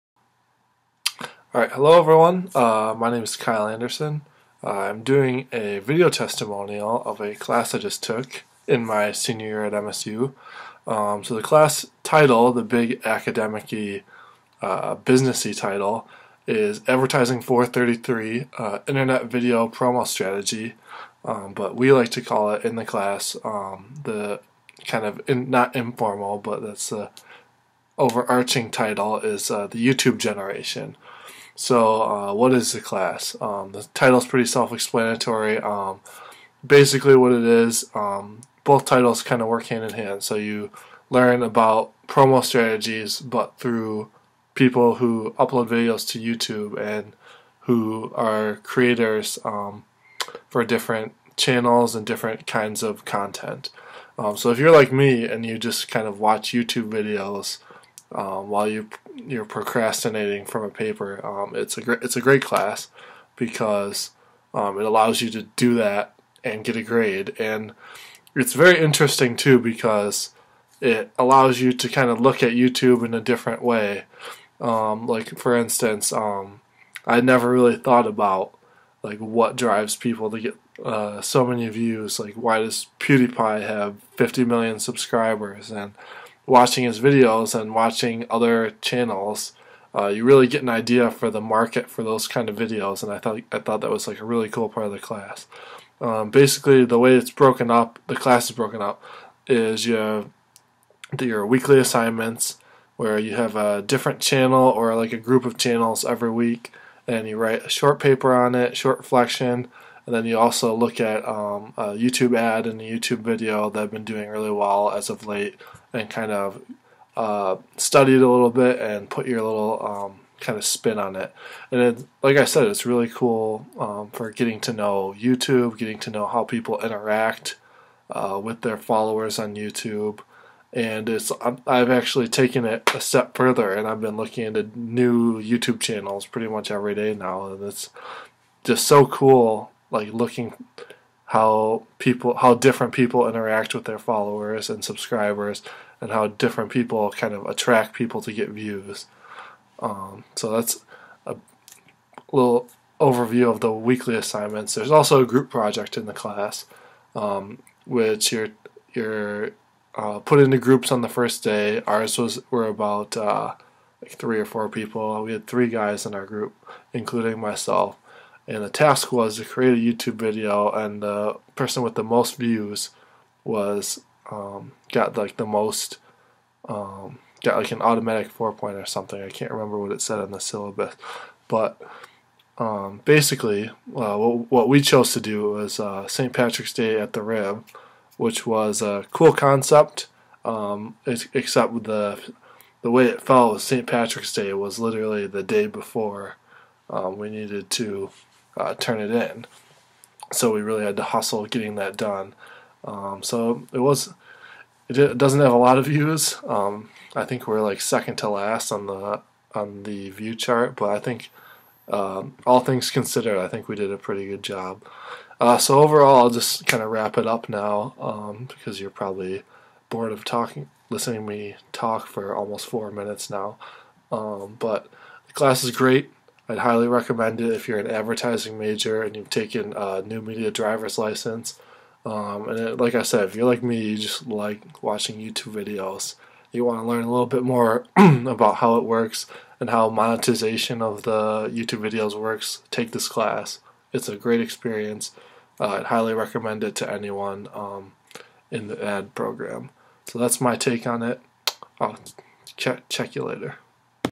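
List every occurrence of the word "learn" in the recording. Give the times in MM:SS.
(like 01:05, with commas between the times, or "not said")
00:41, 03:56.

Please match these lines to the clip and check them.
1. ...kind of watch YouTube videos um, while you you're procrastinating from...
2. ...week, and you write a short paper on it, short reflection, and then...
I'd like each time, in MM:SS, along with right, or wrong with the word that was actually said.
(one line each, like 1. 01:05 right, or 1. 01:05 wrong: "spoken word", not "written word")
1. 00:55 right
2. 01:46 right.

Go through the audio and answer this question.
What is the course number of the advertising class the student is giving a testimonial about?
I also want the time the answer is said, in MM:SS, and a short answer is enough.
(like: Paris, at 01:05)
433, at 00:16.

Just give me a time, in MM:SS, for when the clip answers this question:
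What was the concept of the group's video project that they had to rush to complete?
03:06.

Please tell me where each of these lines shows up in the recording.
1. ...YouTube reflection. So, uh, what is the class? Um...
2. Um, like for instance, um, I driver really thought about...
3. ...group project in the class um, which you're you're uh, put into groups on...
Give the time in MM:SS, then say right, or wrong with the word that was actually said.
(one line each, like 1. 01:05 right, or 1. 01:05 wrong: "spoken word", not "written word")
1. 00:29 wrong: "generation", not "reflection"
2. 01:14 wrong: "never", not "driver"
3. 02:35 right.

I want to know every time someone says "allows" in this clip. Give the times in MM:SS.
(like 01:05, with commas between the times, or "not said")
01:04, 01:11.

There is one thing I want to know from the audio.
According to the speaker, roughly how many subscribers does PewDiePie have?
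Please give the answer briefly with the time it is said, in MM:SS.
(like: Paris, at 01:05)
50 million, at 01:24.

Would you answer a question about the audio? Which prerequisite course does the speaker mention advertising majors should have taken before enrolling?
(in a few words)
New media driver's license.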